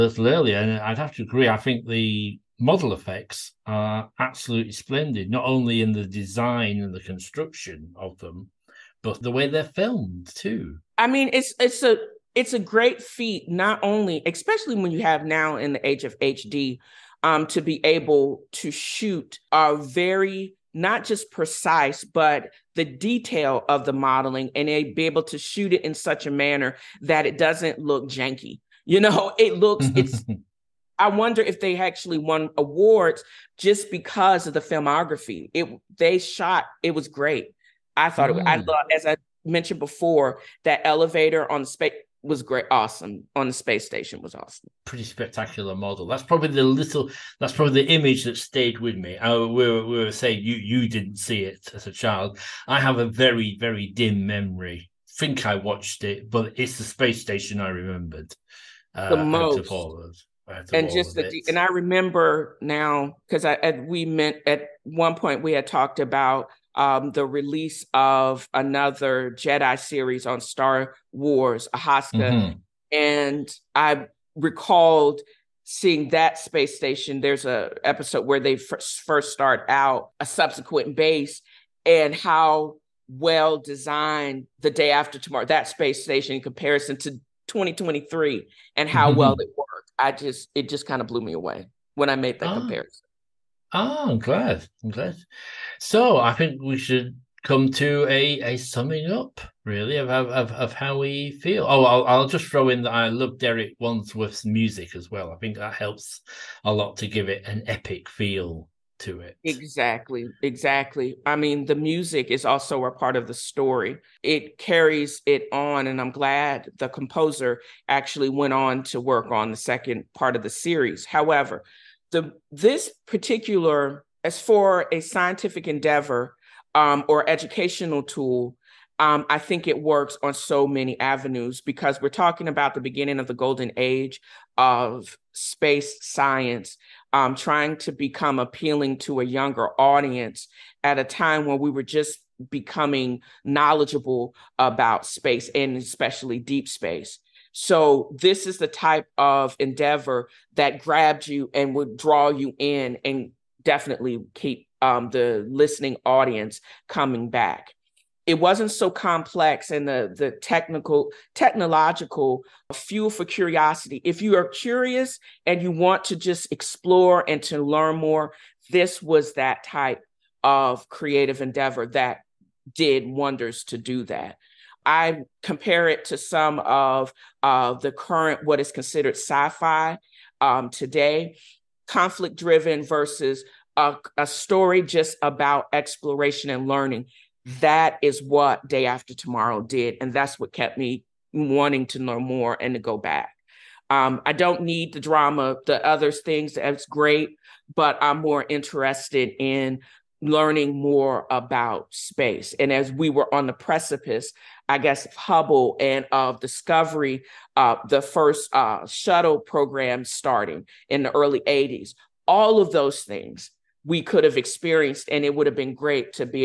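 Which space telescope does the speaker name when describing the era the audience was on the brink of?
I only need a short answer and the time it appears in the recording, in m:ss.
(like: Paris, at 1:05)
Hubble, at 3:25.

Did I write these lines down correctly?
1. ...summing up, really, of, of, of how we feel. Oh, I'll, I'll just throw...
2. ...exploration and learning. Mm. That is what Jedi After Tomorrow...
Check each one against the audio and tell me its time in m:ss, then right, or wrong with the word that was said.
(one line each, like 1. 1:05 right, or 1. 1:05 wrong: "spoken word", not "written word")
1. 1:38 right
2. 3:05 wrong: "Day", not "Jedi".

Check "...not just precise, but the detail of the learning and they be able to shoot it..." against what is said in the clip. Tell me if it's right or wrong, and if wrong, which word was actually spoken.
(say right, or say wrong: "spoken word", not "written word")
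wrong: "modeling", not "learning".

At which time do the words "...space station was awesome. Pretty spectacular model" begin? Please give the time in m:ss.
0:43.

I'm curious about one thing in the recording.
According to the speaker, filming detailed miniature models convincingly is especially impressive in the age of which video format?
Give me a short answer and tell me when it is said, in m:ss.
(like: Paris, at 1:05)
HD, at 0:16.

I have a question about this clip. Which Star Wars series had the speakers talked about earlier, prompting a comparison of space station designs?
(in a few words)
Ahsoka.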